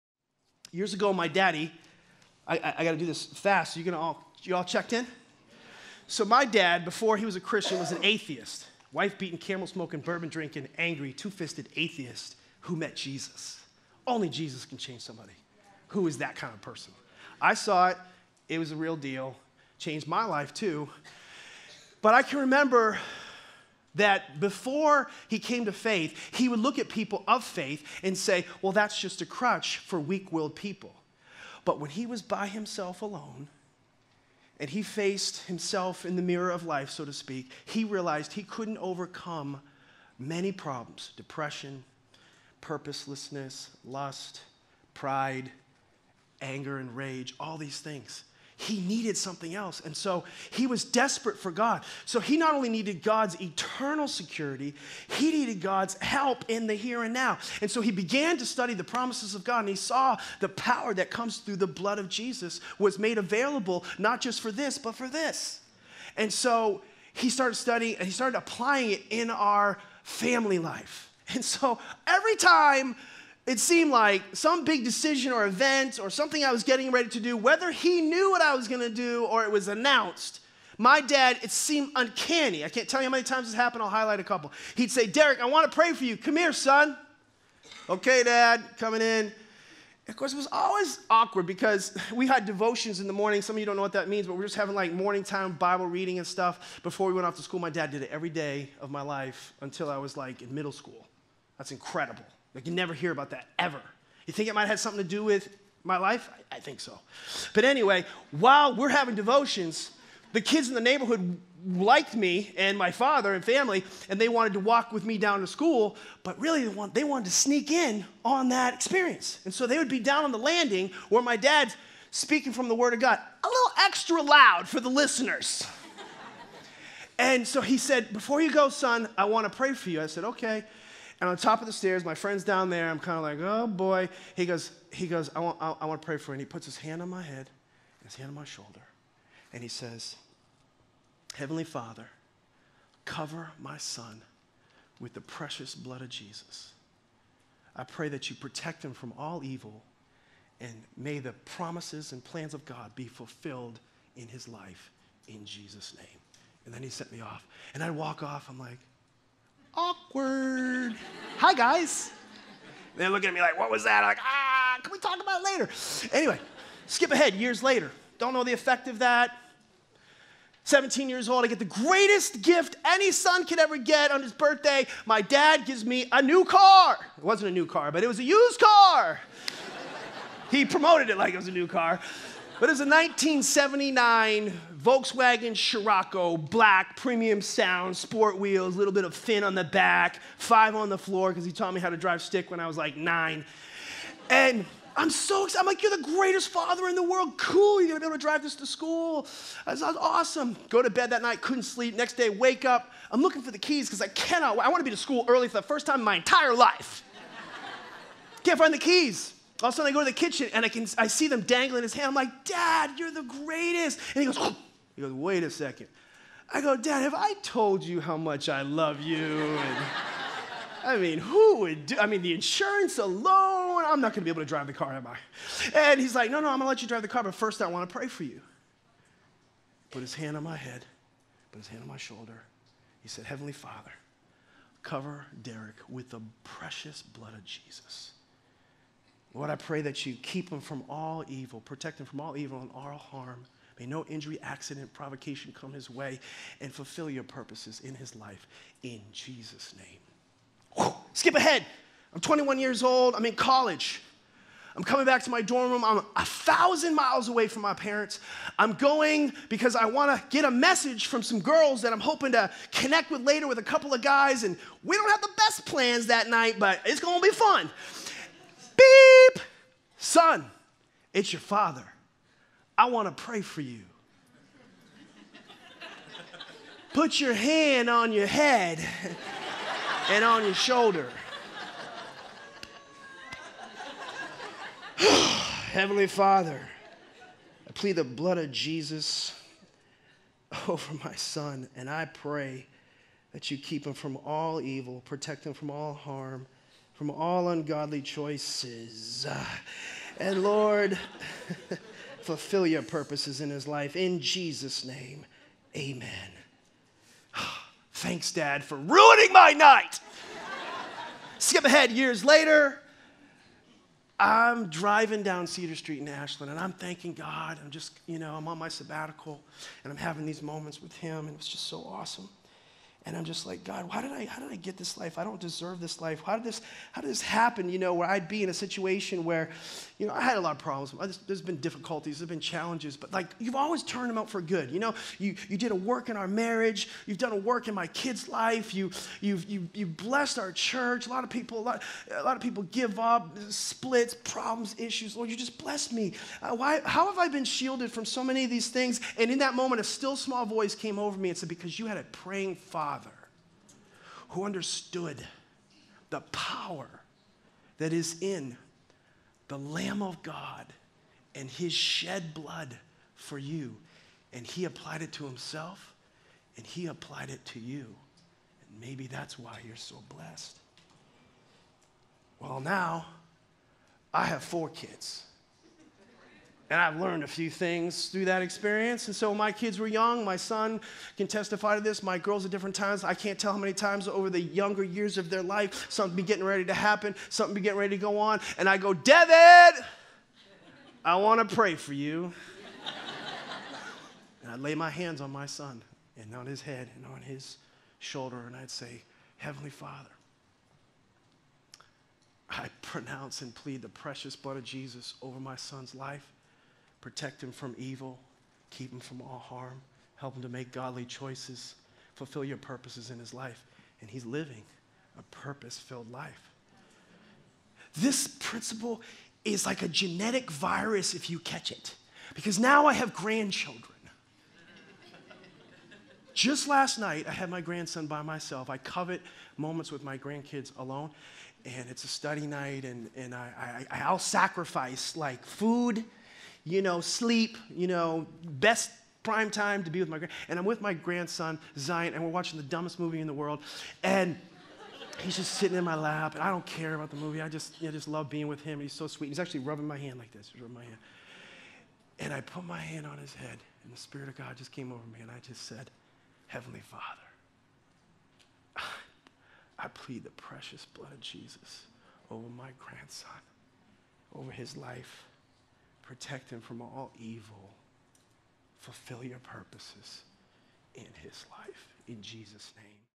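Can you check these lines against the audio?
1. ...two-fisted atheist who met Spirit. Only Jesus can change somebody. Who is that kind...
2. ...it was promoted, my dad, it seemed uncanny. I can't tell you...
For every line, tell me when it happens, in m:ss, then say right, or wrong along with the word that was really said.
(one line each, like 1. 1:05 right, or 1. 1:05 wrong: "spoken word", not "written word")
1. 0:11 wrong: "Jesus", not "Spirit"
2. 1:19 wrong: "announced", not "promoted".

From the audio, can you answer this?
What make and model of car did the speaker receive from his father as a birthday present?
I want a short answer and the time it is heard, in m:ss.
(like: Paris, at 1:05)
Volkswagen Scirocco, at 3:04.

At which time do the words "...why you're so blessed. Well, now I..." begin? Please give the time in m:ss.
6:09.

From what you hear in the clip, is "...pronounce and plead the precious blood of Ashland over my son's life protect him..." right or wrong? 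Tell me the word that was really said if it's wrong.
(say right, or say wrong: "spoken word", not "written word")
wrong: "Jesus", not "Ashland".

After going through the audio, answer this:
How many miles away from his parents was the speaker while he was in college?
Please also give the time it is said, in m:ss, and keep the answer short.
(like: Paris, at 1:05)
1000, at 4:16.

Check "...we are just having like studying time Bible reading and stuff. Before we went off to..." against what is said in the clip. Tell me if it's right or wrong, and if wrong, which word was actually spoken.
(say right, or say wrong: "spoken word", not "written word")
wrong: "morning", not "studying".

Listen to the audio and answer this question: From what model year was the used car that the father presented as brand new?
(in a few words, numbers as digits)
1979.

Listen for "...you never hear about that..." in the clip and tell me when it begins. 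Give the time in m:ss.
1:42.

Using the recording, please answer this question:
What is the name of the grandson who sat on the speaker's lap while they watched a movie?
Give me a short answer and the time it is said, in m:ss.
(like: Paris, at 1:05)
Zion, at 7:21.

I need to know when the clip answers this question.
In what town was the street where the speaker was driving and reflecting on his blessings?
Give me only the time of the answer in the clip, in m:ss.
5:16.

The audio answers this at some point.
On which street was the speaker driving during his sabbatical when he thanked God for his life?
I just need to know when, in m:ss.
5:15.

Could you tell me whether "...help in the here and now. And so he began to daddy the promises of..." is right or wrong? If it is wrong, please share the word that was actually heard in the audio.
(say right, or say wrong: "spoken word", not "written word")
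wrong: "study", not "daddy".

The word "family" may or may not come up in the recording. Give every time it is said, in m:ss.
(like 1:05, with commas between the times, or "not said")
1:10, 1:53.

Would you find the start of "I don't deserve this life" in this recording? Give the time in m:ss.
5:25.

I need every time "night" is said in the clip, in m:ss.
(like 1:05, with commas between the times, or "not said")
3:21, 4:26, 5:09, 7:06, 7:12.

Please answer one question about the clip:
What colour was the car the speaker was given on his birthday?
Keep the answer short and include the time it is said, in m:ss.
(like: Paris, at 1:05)
Black, at 3:06.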